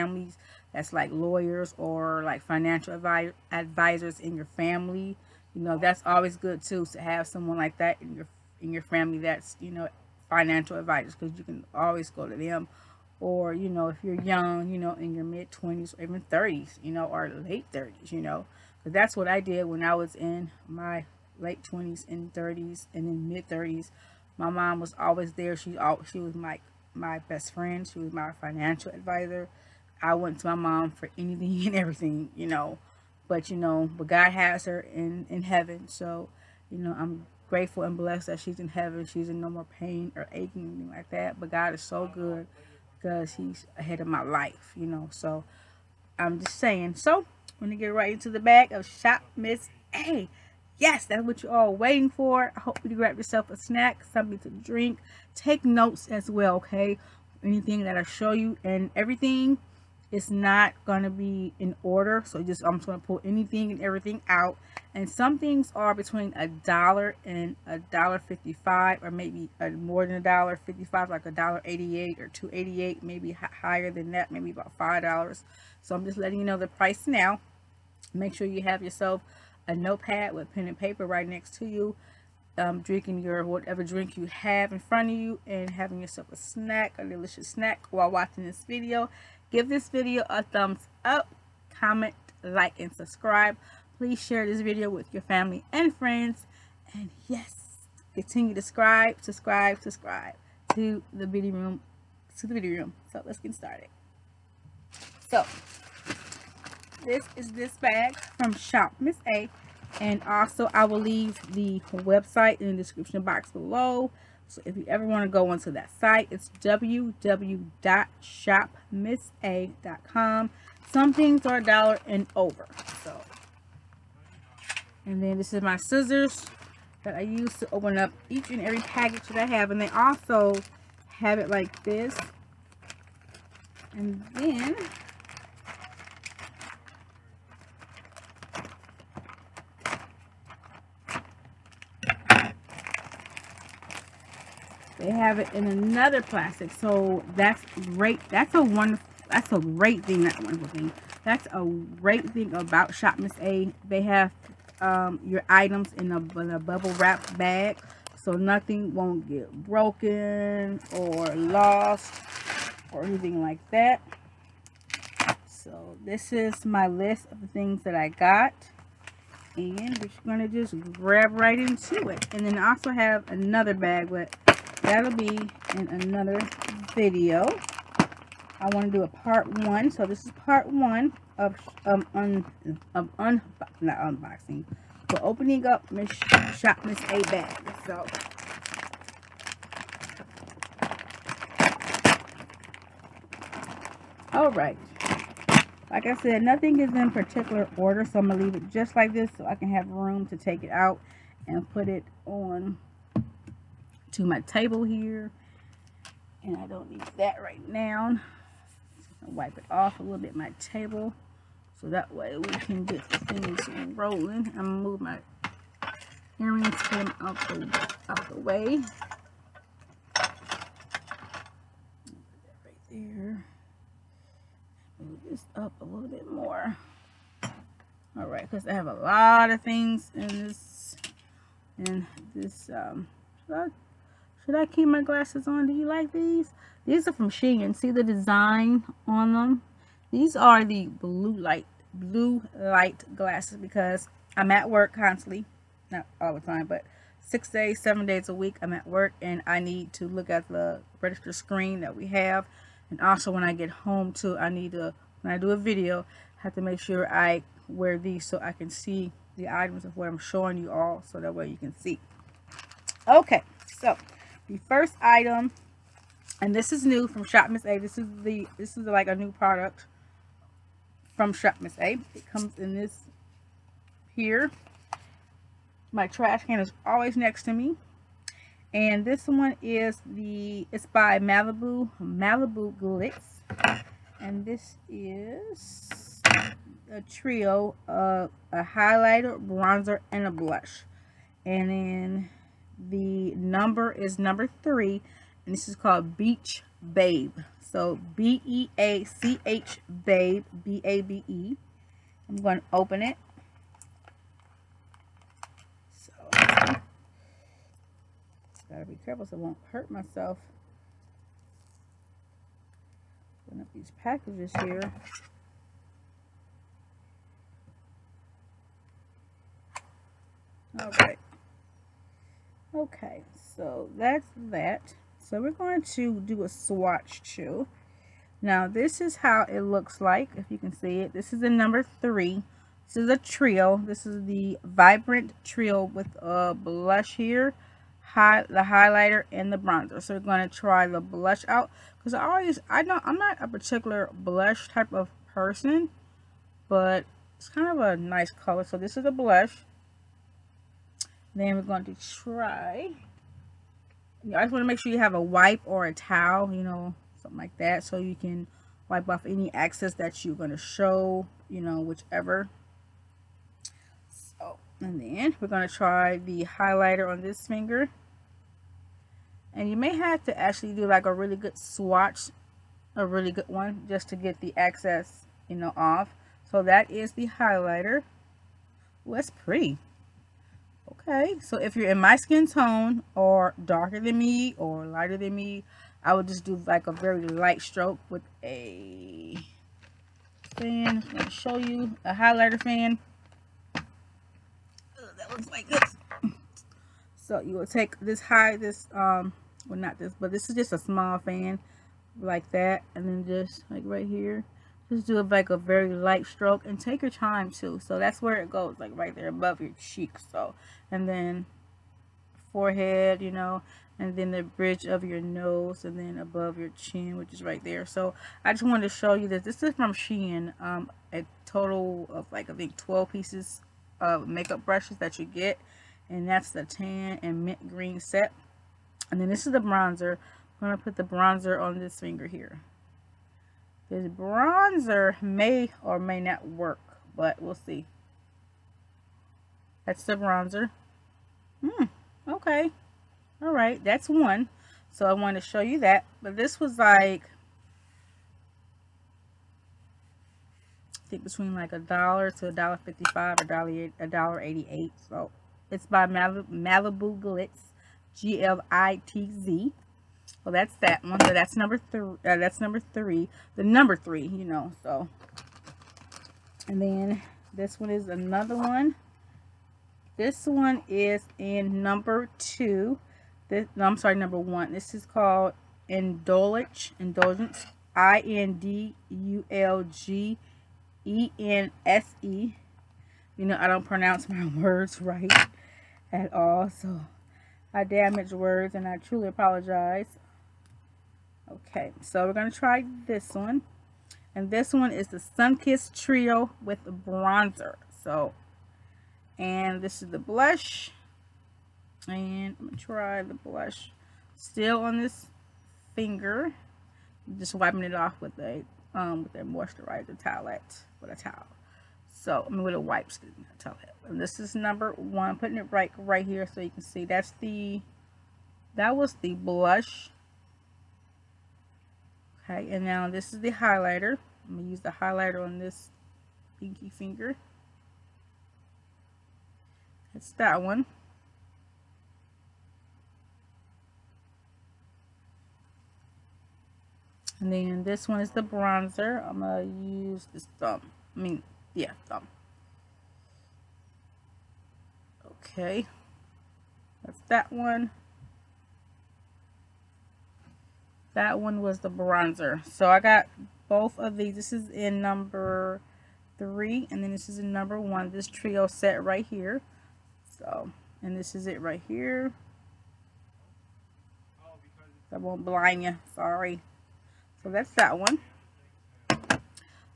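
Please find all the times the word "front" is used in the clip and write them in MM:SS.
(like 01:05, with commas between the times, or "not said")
01:24.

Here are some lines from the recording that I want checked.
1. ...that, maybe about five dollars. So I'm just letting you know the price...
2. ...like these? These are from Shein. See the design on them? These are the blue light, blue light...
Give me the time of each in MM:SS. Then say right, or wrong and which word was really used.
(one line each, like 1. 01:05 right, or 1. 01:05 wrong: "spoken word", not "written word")
1. 01:14 right
2. 03:55 right.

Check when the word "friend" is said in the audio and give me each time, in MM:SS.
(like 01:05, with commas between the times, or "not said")
00:27, 01:35.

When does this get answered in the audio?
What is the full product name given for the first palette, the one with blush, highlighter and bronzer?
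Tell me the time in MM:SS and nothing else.
05:34.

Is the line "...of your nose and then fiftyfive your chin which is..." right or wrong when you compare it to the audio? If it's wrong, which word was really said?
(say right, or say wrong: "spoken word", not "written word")
wrong: "above", not "fiftyfive".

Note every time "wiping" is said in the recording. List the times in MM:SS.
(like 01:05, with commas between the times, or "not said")
08:27.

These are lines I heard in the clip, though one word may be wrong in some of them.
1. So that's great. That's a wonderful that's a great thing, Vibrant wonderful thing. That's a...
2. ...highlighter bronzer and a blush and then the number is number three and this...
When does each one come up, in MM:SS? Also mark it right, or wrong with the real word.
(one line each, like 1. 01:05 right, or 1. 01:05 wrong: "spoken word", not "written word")
1. 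02:26 wrong: "That", not "Vibrant"
2. 04:48 right.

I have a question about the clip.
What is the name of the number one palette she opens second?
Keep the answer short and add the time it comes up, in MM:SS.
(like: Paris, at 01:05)
Indulgence, at 07:56.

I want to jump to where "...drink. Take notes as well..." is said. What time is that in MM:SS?
00:54.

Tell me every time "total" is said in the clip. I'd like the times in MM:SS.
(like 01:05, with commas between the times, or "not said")
07:01.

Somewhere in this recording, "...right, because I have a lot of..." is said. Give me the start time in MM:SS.
03:48.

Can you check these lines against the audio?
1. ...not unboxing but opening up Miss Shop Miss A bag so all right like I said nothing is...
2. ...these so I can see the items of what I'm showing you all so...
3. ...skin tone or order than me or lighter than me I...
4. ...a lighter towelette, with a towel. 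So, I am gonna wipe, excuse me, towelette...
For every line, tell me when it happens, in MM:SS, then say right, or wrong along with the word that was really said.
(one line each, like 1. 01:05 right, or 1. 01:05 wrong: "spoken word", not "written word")
1. 03:03 right
2. 04:17 right
3. 06:22 wrong: "darker", not "order"
4. 08:29 wrong: "moisturizer", not "lighter".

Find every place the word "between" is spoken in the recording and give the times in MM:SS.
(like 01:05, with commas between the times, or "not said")
01:05, 07:31.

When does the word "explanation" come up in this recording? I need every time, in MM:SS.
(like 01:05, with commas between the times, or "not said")
not said.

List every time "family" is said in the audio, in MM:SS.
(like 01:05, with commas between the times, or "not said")
00:04, 00:08, 01:35.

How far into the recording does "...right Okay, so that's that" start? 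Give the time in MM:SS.
05:21.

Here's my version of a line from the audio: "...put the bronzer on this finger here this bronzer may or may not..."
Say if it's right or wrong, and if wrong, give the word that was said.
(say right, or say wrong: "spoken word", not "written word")
right.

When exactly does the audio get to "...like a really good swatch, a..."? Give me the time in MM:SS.
06:10.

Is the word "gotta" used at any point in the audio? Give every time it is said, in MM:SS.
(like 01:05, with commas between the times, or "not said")
05:06.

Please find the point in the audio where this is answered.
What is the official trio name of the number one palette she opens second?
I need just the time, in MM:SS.
08:15.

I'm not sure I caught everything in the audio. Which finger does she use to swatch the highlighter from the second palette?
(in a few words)
pinky finger.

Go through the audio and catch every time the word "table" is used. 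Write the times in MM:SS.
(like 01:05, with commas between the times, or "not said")
03:24, 03:30.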